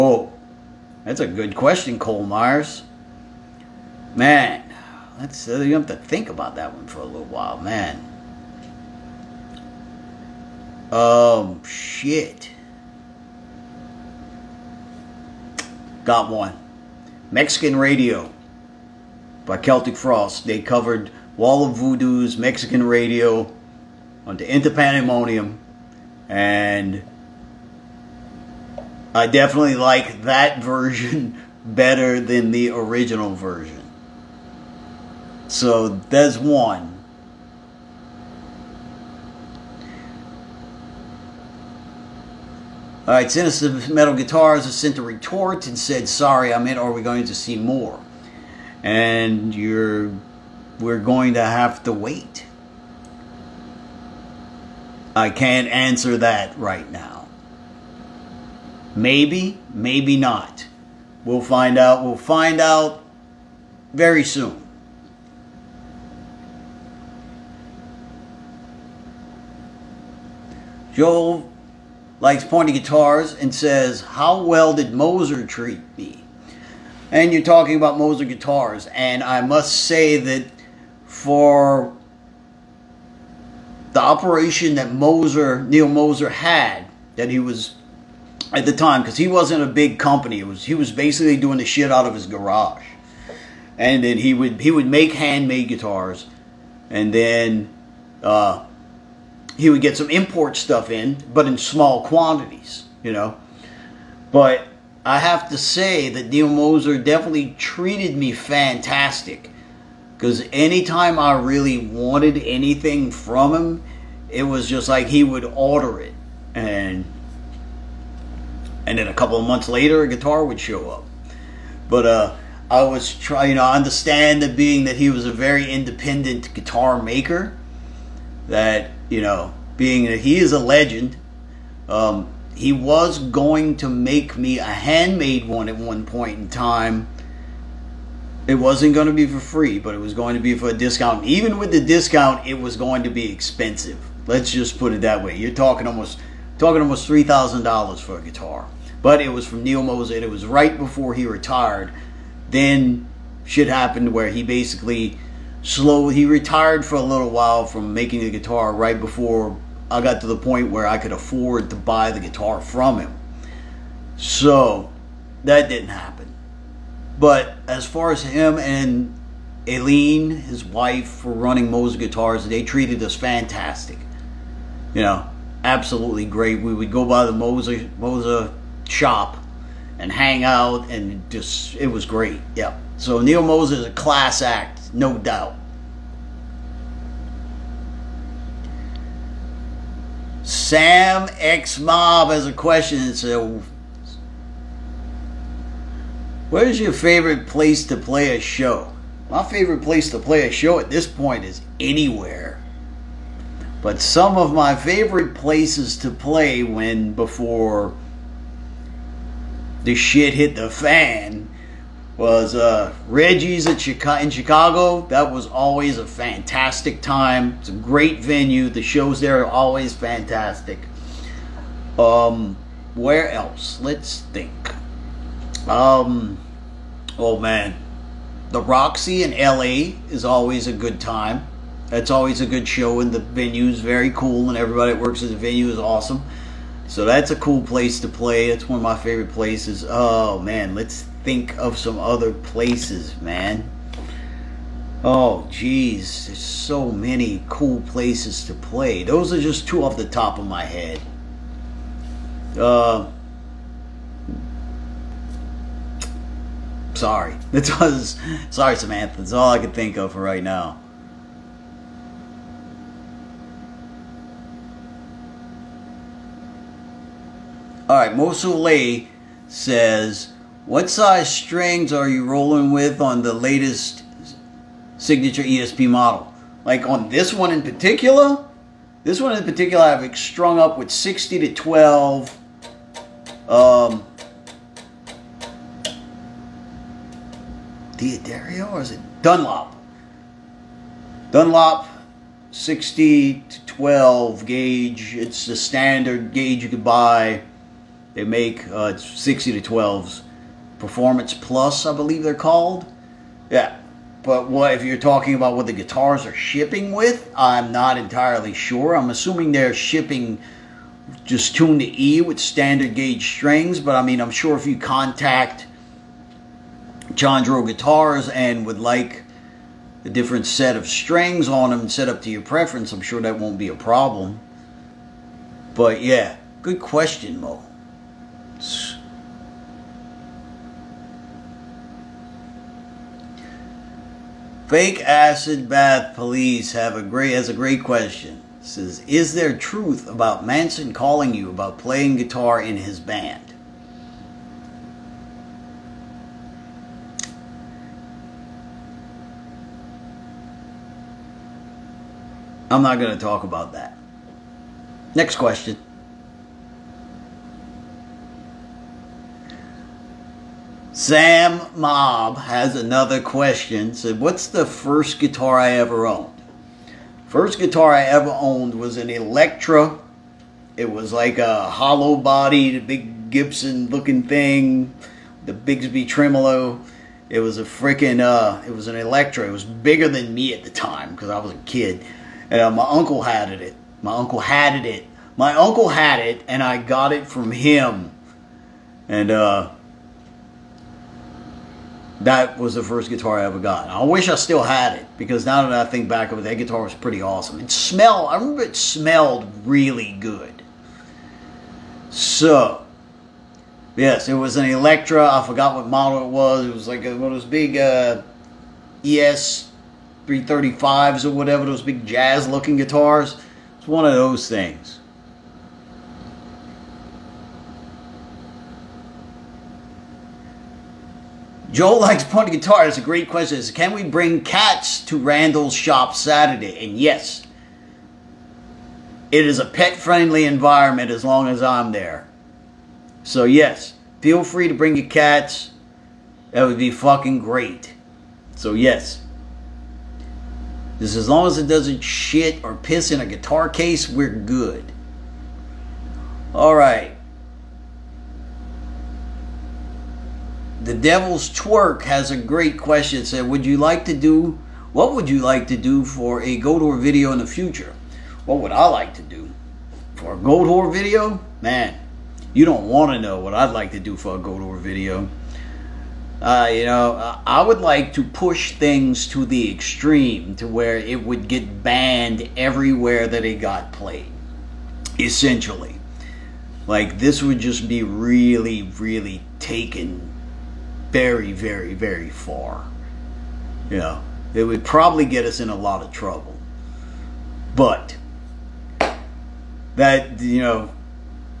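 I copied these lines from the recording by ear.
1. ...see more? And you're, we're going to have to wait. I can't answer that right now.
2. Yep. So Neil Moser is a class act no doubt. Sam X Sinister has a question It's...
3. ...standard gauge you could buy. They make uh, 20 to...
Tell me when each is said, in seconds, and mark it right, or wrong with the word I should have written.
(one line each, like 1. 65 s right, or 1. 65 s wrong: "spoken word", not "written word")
1. 47 s right
2. 182 s wrong: "Mob", not "Sinister"
3. 295 s wrong: "60", not "20".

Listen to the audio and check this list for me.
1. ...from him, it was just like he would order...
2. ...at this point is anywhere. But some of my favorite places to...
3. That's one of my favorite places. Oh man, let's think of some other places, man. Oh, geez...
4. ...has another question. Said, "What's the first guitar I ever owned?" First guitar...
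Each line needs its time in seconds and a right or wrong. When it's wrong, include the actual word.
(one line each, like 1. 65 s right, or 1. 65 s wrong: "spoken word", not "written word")
1. 113 s right
2. 200 s right
3. 238 s right
4. 362 s right.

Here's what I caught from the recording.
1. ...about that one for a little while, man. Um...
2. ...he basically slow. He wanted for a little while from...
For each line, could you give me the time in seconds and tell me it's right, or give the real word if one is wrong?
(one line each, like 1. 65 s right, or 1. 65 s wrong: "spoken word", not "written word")
1. 6 s right
2. 154 s wrong: "retired", not "wanted".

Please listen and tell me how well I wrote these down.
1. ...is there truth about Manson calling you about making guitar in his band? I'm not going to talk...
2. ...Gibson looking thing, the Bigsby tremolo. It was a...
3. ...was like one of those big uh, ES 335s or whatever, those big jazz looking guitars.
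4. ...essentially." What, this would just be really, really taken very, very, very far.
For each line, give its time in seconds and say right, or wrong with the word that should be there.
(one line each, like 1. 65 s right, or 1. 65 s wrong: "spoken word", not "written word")
1. 339 s wrong: "playing", not "making"
2. 373 s right
3. 406 s right
4. 475 s wrong: "Like", not "What".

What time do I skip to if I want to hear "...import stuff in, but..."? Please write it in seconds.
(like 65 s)
100 s.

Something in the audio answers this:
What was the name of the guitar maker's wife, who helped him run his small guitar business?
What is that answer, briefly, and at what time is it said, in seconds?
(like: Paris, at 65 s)
Aileen, at 169 s.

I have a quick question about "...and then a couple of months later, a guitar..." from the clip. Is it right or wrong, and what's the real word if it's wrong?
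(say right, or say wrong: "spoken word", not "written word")
right.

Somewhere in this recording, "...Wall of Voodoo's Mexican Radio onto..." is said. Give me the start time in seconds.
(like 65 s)
21 s.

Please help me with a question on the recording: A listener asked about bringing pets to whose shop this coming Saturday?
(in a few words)
Randall's.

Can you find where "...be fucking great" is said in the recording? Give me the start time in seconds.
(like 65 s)
436 s.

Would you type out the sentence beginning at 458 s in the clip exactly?
What would I like to do for a Goatwhore video?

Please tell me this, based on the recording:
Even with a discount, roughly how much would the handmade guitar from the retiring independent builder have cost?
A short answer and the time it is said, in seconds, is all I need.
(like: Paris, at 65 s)
$3000, at 147 s.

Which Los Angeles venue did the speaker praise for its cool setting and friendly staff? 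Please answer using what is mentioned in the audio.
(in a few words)
The Roxy.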